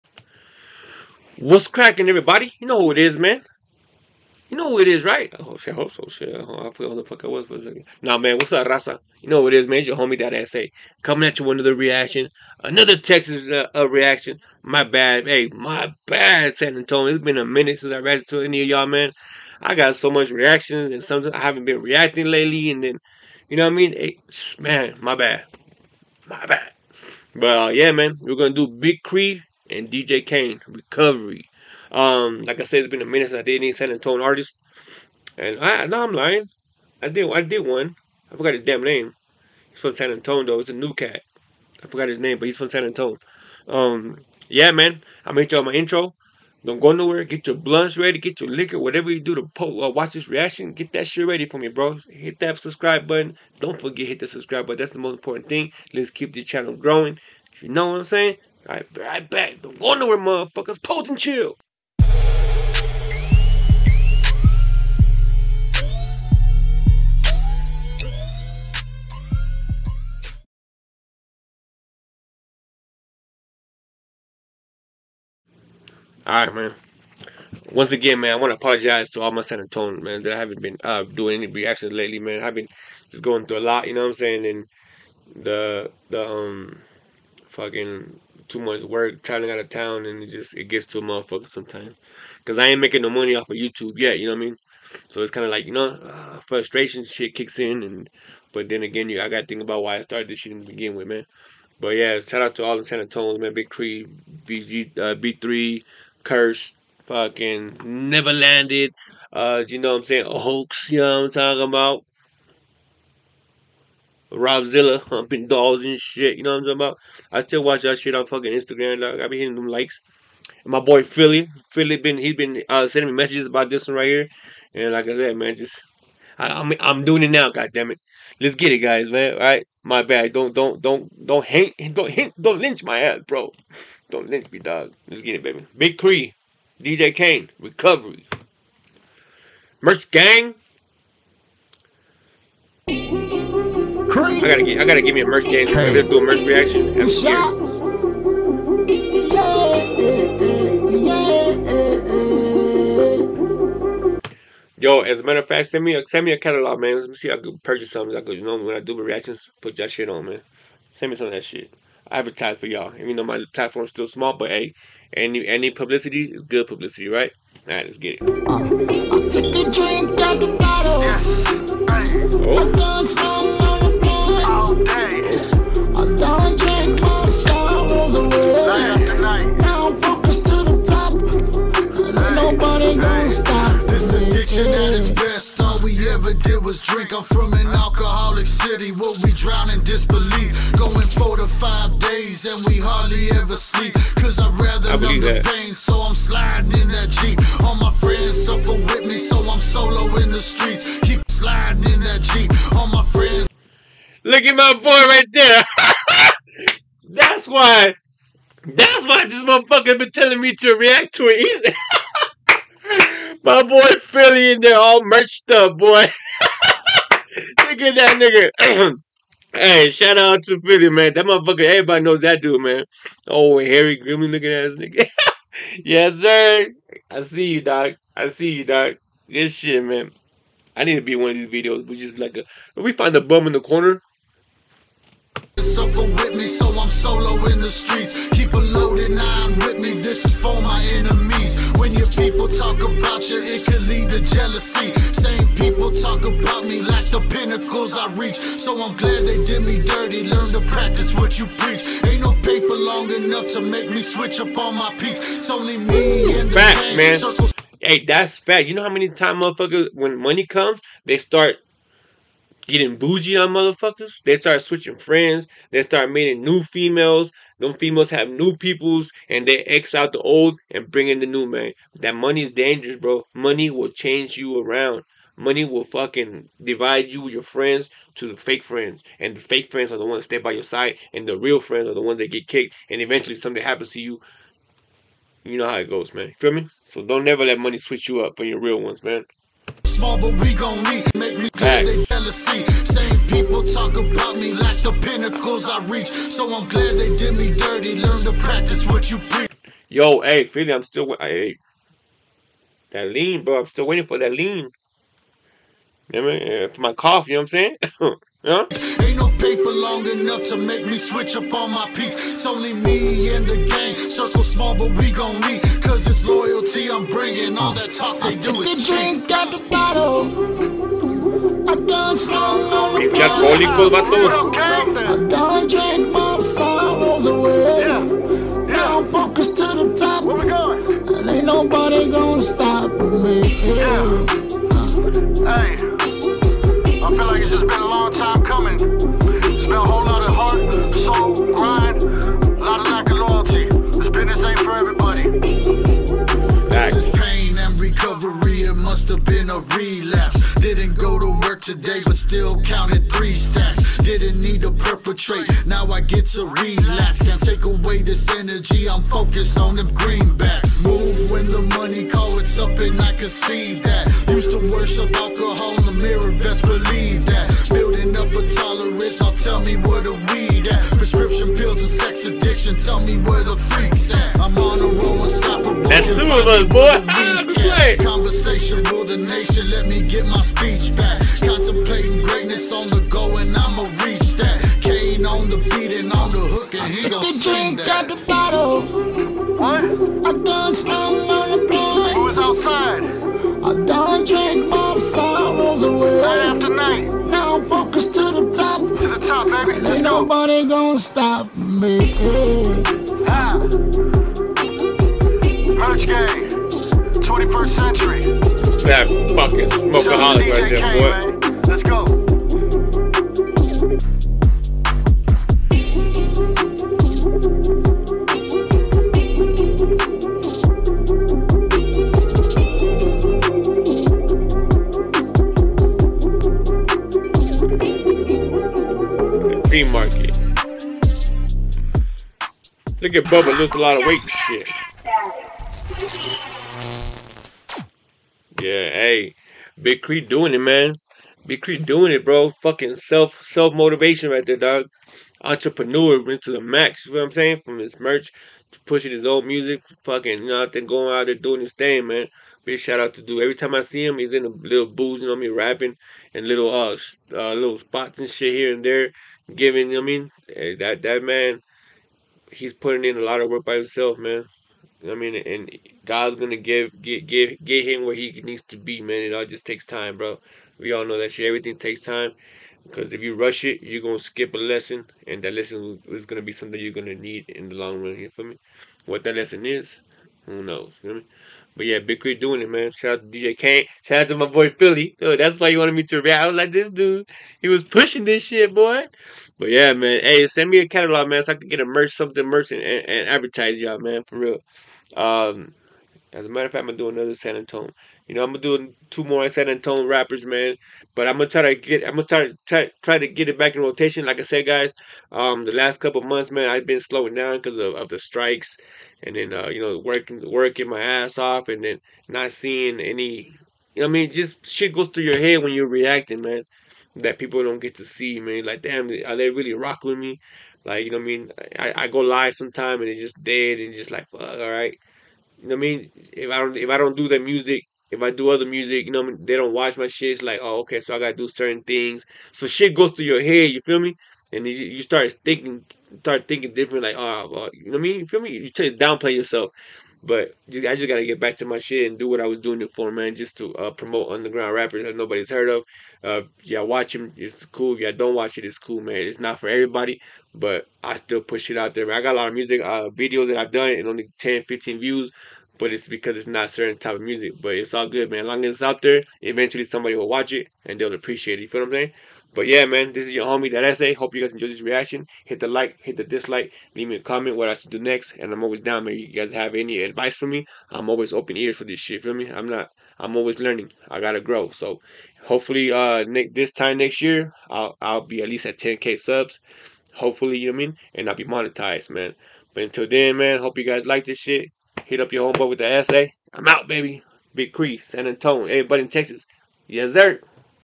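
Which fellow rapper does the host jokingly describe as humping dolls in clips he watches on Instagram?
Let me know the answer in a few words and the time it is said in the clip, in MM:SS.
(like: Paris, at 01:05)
Robzilla, at 01:54.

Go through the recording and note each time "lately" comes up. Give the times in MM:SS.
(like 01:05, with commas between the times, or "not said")
00:22, 01:21.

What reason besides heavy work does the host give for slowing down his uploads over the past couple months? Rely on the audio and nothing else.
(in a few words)
The strikes.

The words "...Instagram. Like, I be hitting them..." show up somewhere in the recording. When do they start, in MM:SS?
01:58.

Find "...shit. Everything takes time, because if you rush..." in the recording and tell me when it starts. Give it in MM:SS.
07:51.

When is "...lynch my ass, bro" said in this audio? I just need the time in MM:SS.
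02:12.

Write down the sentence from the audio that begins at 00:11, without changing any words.
Coming at you with another reaction.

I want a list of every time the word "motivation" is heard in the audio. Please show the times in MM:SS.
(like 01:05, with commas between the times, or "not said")
07:23.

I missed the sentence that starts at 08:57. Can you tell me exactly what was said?
Like, oh, well, you know what I mean?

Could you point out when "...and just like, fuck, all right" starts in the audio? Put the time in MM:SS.
08:43.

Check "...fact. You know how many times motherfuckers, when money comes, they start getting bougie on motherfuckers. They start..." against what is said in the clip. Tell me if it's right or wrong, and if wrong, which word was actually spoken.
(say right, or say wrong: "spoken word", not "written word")
right.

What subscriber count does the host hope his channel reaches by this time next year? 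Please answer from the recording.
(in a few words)
10k.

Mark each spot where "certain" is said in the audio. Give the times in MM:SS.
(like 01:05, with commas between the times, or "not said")
08:51, 09:16.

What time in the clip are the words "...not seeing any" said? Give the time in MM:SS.
08:32.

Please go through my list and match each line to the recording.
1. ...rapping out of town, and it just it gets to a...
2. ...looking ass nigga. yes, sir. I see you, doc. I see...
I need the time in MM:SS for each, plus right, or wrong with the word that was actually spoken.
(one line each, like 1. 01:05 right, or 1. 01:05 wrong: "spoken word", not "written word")
1. 01:29 wrong: "traveling", not "rapping"
2. 03:44 right.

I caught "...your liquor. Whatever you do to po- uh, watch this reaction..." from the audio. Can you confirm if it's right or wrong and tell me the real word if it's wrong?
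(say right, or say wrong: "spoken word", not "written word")
right.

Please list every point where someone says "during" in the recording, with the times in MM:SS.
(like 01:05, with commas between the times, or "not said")
not said.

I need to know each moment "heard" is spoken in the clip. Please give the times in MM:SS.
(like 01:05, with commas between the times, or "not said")
09:05.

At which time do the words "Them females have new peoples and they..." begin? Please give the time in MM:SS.
04:27.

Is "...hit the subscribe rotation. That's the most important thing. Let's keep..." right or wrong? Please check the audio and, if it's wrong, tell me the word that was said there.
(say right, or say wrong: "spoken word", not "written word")
wrong: "button", not "rotation".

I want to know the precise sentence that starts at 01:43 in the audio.
Big Kree, BG, uh, B3, Kerst, fucking Neva Landed.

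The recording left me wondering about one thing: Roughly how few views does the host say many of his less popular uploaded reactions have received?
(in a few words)
10 to 15.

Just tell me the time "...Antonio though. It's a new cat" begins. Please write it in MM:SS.
00:40.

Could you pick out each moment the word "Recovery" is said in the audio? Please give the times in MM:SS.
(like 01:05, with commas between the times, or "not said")
00:30, 02:17.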